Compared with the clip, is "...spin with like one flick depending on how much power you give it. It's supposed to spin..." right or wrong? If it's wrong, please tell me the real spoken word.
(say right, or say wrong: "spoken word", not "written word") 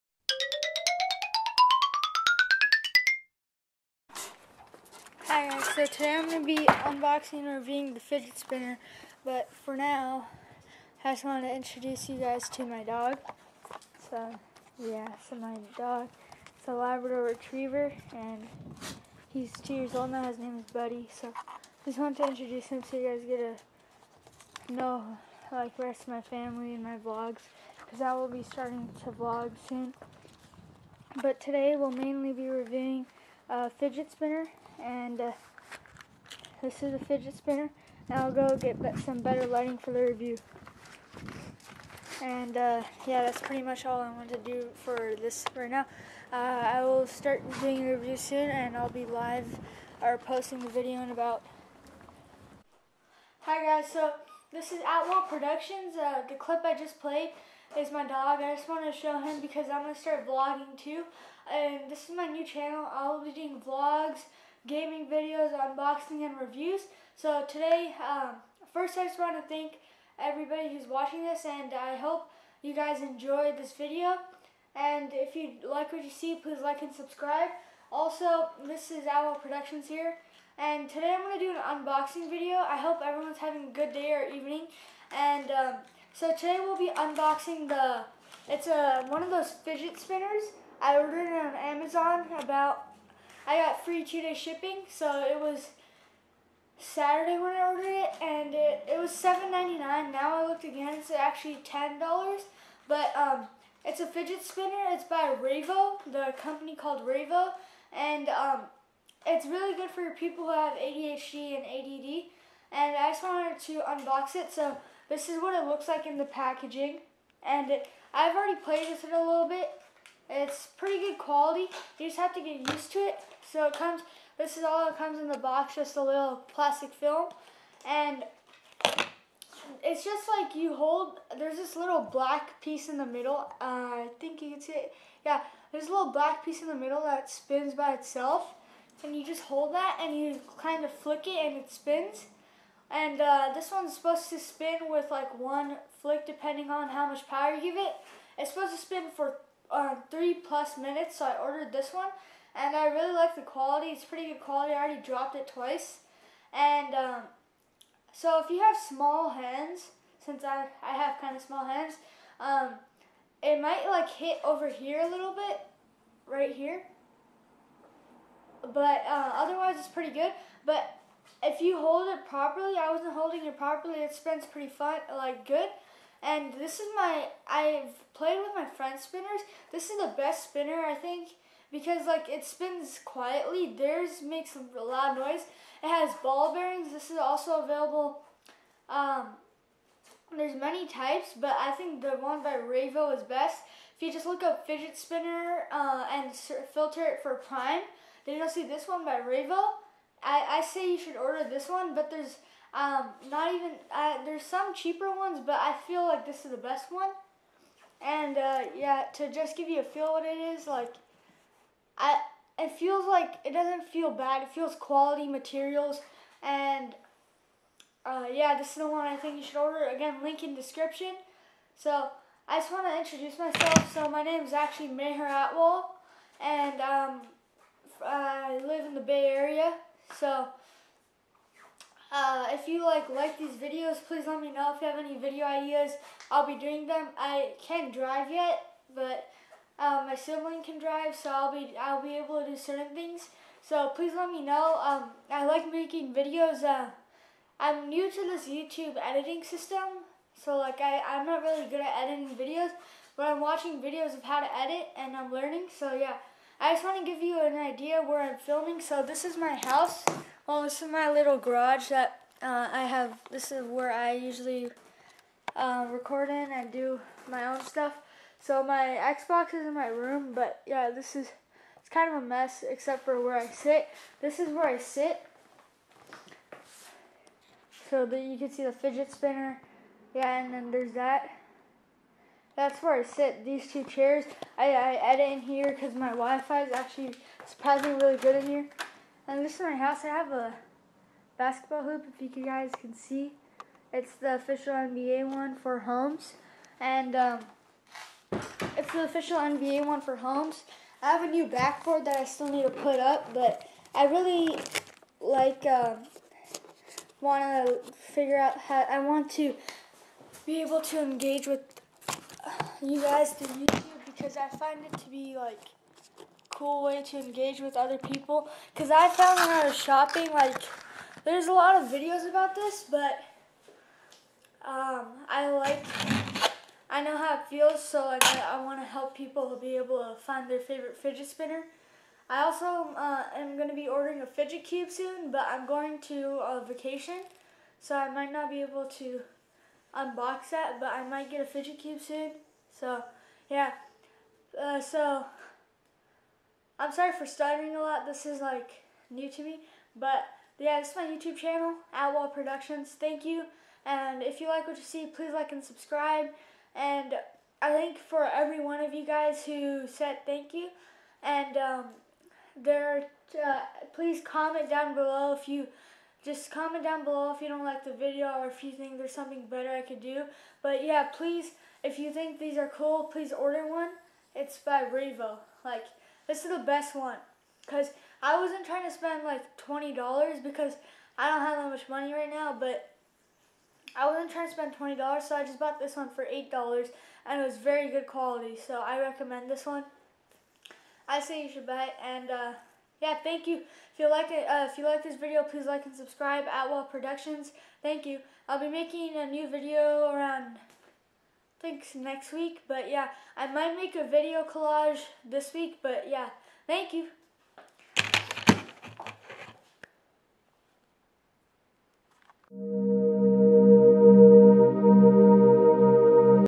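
right.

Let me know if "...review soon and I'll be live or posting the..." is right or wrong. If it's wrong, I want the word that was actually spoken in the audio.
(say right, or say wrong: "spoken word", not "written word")
right.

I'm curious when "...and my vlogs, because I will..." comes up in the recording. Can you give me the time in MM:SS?
00:26.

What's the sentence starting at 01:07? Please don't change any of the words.
So today, um, first I just want to thank everybody who's watching this, and I hope you guys enjoyed this video.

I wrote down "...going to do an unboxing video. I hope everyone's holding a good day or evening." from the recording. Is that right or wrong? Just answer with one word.
wrong.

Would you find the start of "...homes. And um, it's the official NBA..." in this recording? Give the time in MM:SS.
04:55.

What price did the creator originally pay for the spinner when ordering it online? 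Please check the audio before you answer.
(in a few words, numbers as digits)
$7.99.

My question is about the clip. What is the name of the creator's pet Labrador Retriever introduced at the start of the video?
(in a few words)
Buddy.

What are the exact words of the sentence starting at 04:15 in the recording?
So yeah, I just want to give you an idea where I'm filming.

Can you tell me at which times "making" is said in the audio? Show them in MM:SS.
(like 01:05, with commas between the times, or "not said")
04:05, 06:38.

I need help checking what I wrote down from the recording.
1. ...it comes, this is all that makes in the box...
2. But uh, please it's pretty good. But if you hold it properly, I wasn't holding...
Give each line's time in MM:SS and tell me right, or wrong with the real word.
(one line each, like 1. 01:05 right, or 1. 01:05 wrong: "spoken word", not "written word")
1. 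02:03 wrong: "comes", not "makes"
2. 02:48 wrong: "otherwise", not "please".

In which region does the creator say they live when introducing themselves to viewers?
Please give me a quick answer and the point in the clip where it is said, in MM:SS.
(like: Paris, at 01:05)
Bay Area, at 03:49.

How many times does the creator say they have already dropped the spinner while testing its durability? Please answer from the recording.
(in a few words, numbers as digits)
Twice.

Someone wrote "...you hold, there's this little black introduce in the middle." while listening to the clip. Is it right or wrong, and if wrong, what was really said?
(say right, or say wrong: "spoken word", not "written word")
wrong: "piece", not "introduce".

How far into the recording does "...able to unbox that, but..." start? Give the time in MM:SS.
05:38.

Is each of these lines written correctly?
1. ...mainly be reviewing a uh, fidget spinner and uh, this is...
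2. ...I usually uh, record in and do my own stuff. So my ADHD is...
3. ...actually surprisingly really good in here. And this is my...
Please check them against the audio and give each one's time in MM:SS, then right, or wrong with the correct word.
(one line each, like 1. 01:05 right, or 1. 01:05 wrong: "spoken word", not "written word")
1. 00:31 right
2. 04:23 wrong: "Xbox", not "ADHD"
3. 04:46 right.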